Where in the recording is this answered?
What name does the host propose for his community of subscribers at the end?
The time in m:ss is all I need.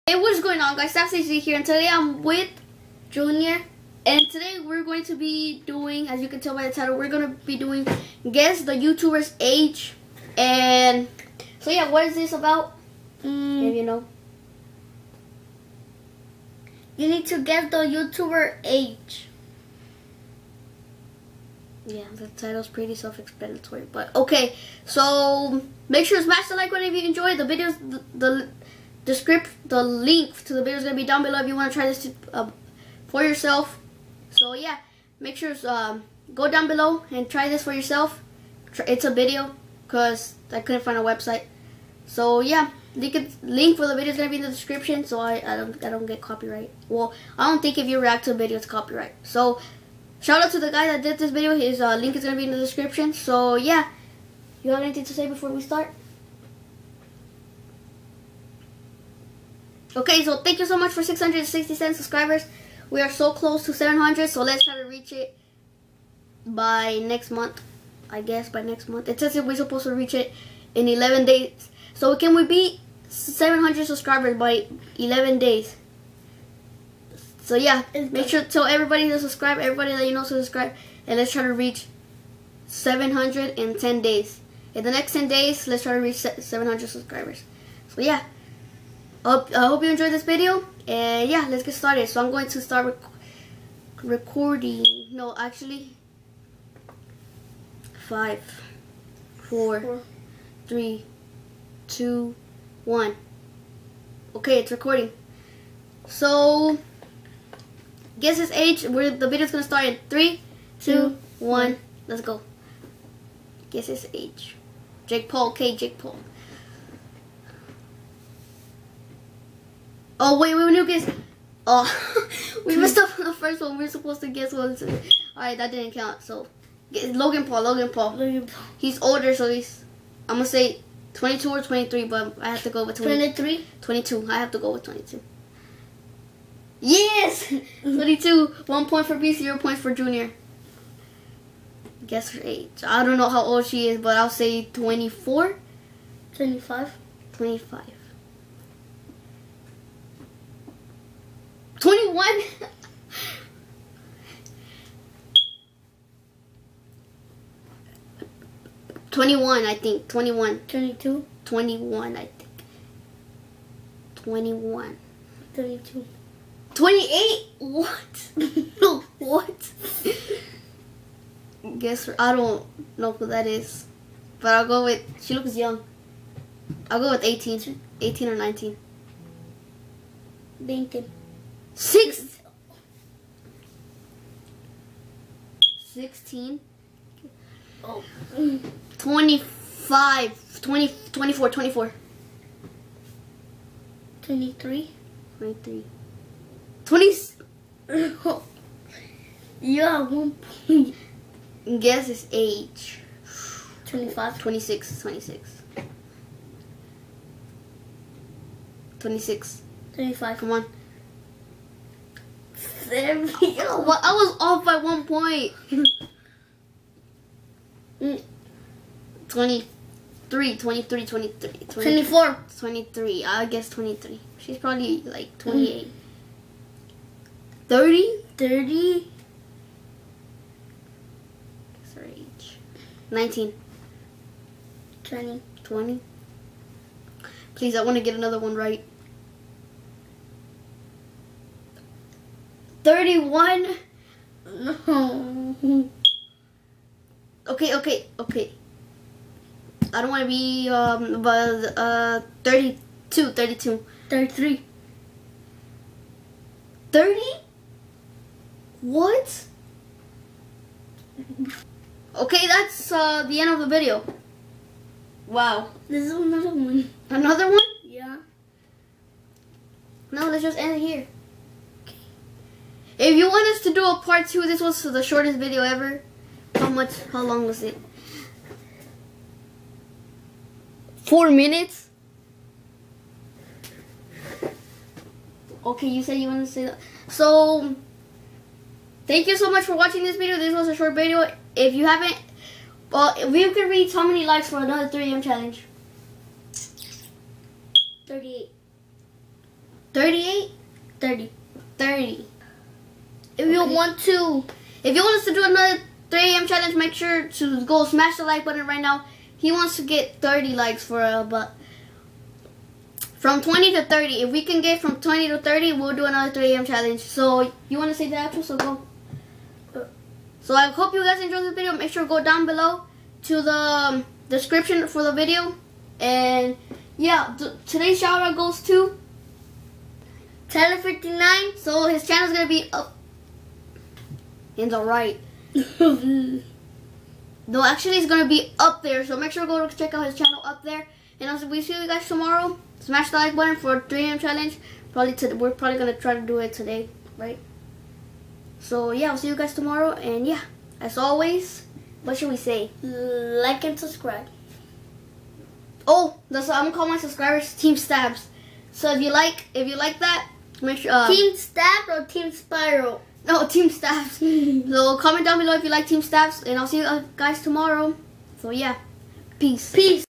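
5:57.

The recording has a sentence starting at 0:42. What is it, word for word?
So yeah, link, link for the video is going to be in the description so I, I, don't, I don't get copyright.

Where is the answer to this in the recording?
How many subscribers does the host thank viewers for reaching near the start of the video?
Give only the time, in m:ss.
1:01.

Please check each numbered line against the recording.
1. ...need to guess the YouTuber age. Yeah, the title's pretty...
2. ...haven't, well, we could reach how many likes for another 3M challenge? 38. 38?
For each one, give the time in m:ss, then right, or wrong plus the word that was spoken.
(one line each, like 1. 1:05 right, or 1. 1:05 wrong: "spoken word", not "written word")
1. 0:17 right
2. 4:51 right.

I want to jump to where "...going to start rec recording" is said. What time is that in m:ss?
1:32.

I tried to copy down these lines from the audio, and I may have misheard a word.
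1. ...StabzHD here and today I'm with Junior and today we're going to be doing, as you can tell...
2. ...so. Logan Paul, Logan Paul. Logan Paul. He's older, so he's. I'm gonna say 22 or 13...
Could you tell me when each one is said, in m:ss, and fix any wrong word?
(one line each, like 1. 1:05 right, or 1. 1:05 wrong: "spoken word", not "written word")
1. 0:00 right
2. 2:06 wrong: "23", not "13".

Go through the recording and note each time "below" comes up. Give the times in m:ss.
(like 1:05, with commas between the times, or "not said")
0:31, 0:36, 5:22, 6:05.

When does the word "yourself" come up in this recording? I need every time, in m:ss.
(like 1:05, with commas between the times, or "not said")
0:33, 0:37.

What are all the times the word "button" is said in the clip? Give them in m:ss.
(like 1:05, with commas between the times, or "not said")
0:26, 5:08, 5:43.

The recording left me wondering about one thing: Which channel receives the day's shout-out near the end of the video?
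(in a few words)
Tyler59.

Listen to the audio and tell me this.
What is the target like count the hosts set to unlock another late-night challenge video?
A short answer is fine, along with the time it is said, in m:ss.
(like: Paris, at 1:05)
30, at 5:10.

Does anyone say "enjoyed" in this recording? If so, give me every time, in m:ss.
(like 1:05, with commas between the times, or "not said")
0:27, 1:29, 5:21.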